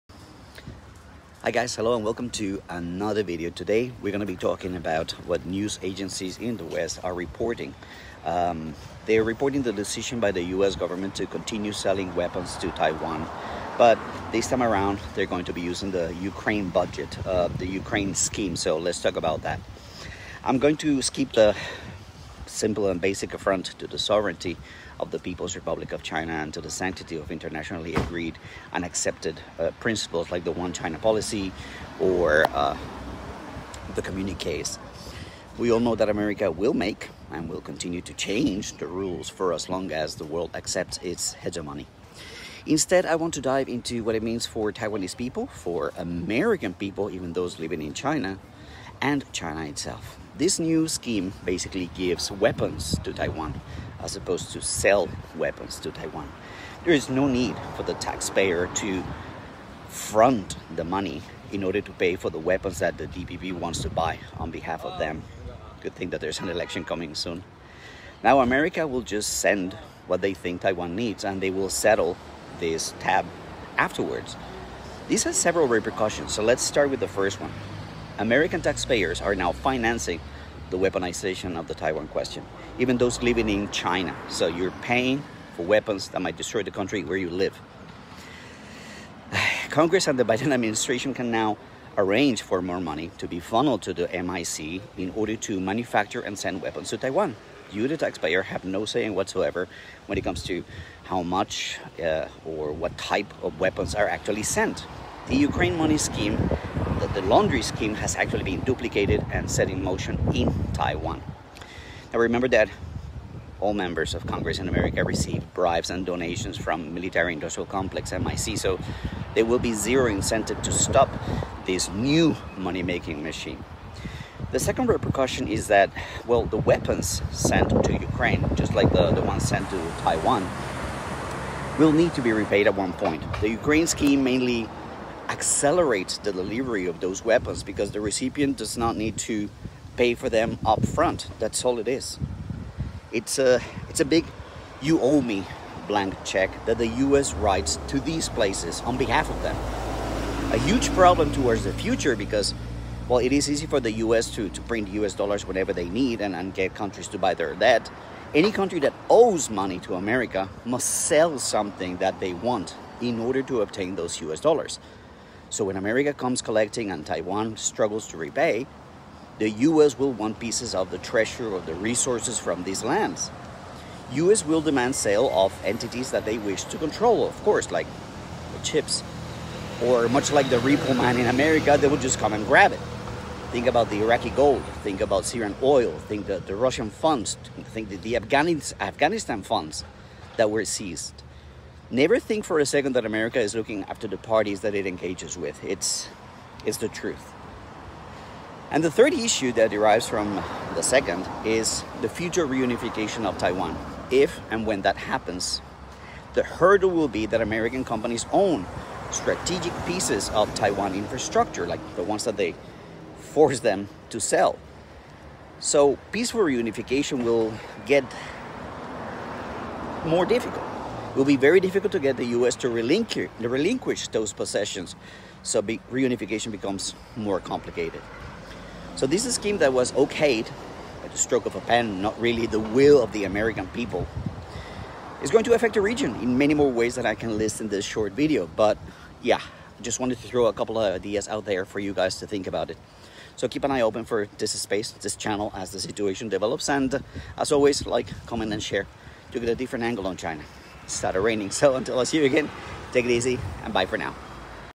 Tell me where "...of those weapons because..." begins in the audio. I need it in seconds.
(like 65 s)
136 s.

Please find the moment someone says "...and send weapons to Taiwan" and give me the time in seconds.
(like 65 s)
96 s.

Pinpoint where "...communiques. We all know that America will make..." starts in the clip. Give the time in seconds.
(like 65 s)
34 s.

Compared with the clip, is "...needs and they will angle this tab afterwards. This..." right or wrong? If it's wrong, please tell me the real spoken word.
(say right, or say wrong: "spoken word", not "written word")
wrong: "settle", not "angle".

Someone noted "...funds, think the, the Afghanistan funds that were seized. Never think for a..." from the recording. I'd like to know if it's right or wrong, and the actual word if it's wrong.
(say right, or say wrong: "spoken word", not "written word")
right.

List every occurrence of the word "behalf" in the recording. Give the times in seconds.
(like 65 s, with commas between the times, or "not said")
64 s, 148 s.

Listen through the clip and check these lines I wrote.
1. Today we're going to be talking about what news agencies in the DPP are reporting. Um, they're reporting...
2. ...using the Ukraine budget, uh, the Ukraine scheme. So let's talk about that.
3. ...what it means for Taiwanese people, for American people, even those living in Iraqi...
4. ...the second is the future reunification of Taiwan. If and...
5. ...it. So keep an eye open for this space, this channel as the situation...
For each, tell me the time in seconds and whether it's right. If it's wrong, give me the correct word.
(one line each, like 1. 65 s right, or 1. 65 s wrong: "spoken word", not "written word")
1. 3 s wrong: "West", not "DPP"
2. 15 s right
3. 44 s wrong: "China", not "Iraqi"
4. 200 s right
5. 242 s right.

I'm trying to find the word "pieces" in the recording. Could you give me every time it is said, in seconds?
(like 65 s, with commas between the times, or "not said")
170 s, 209 s.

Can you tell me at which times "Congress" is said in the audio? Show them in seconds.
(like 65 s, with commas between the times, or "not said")
89 s, 114 s.